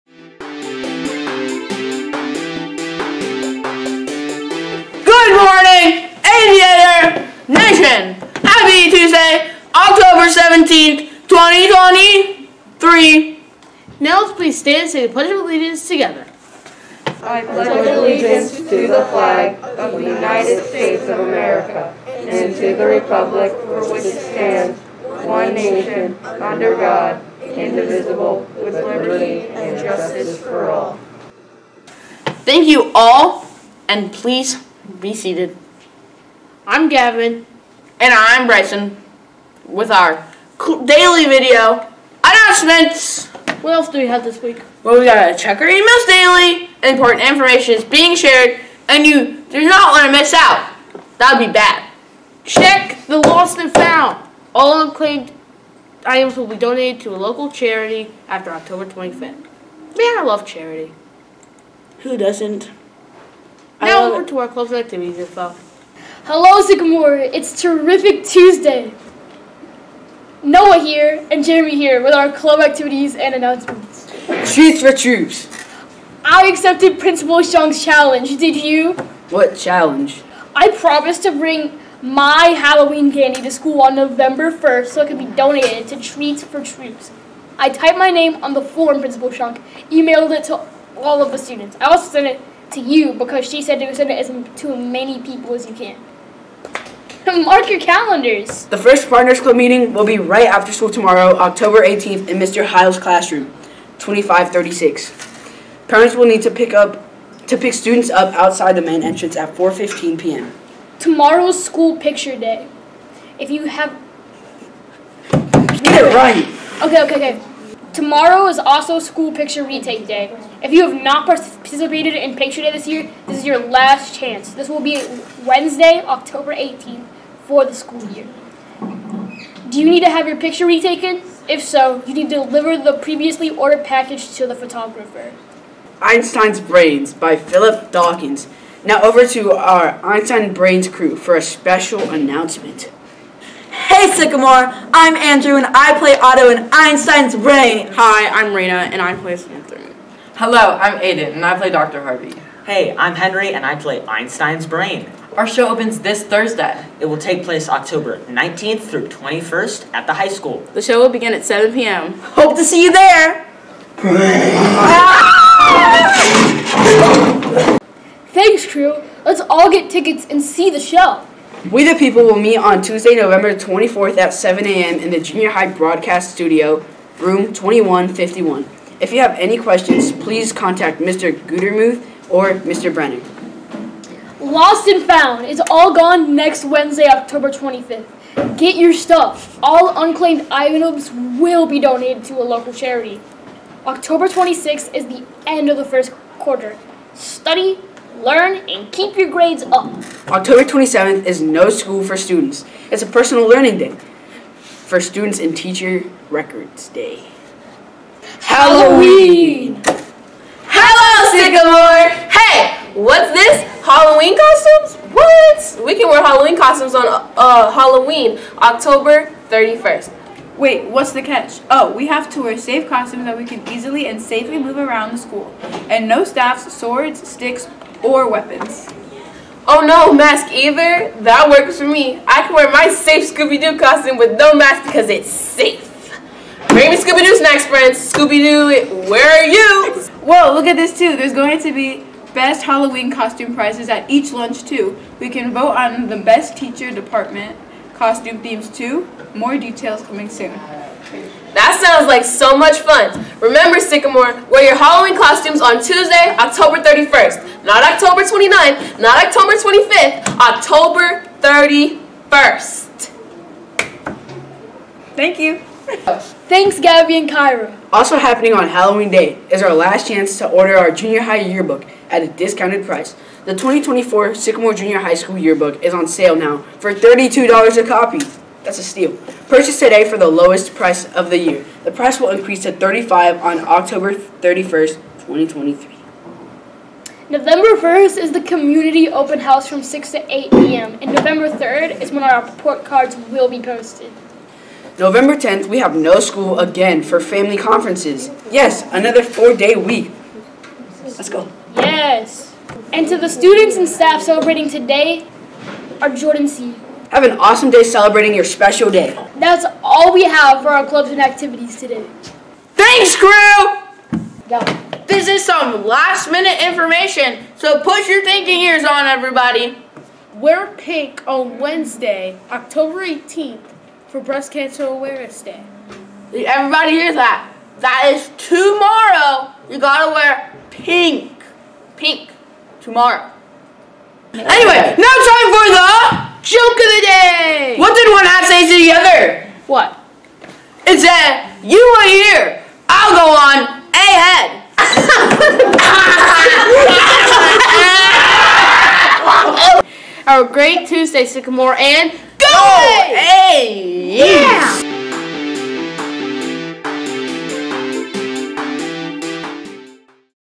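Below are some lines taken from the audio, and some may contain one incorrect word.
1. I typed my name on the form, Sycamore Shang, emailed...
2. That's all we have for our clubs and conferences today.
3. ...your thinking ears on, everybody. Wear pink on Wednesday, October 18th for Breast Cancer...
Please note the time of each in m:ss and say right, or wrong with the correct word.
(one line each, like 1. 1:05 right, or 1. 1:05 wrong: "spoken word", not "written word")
1. 1:27 wrong: "Principal", not "Sycamore"
2. 5:09 wrong: "activities", not "conferences"
3. 5:18 right.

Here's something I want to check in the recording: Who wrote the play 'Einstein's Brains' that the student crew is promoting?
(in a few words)
Philip Dawkins.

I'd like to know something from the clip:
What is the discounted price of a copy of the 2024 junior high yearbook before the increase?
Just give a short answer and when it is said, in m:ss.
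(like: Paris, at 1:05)
$32, at 4:36.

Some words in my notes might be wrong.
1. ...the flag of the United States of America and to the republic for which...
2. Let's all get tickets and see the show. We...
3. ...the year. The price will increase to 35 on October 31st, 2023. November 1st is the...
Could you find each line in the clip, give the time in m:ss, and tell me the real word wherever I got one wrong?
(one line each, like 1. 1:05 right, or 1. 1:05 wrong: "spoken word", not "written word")
1. 0:18 right
2. 2:49 right
3. 4:41 right.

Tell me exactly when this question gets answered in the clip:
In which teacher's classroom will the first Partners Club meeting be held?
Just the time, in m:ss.
1:42.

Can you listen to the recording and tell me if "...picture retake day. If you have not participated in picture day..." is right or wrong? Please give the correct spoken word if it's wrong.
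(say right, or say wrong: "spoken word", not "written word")
right.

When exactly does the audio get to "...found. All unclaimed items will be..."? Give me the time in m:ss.
0:53.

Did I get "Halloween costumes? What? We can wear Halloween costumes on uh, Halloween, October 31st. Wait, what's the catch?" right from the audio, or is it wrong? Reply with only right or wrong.
right.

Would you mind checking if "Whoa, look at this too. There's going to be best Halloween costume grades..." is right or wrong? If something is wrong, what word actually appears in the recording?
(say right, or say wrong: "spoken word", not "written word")
wrong: "prizes", not "grades".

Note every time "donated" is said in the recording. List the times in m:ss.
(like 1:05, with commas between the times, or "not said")
0:56, 1:25, 3:11.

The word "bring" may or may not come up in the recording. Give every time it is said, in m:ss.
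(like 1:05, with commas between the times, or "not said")
1:21, 3:56.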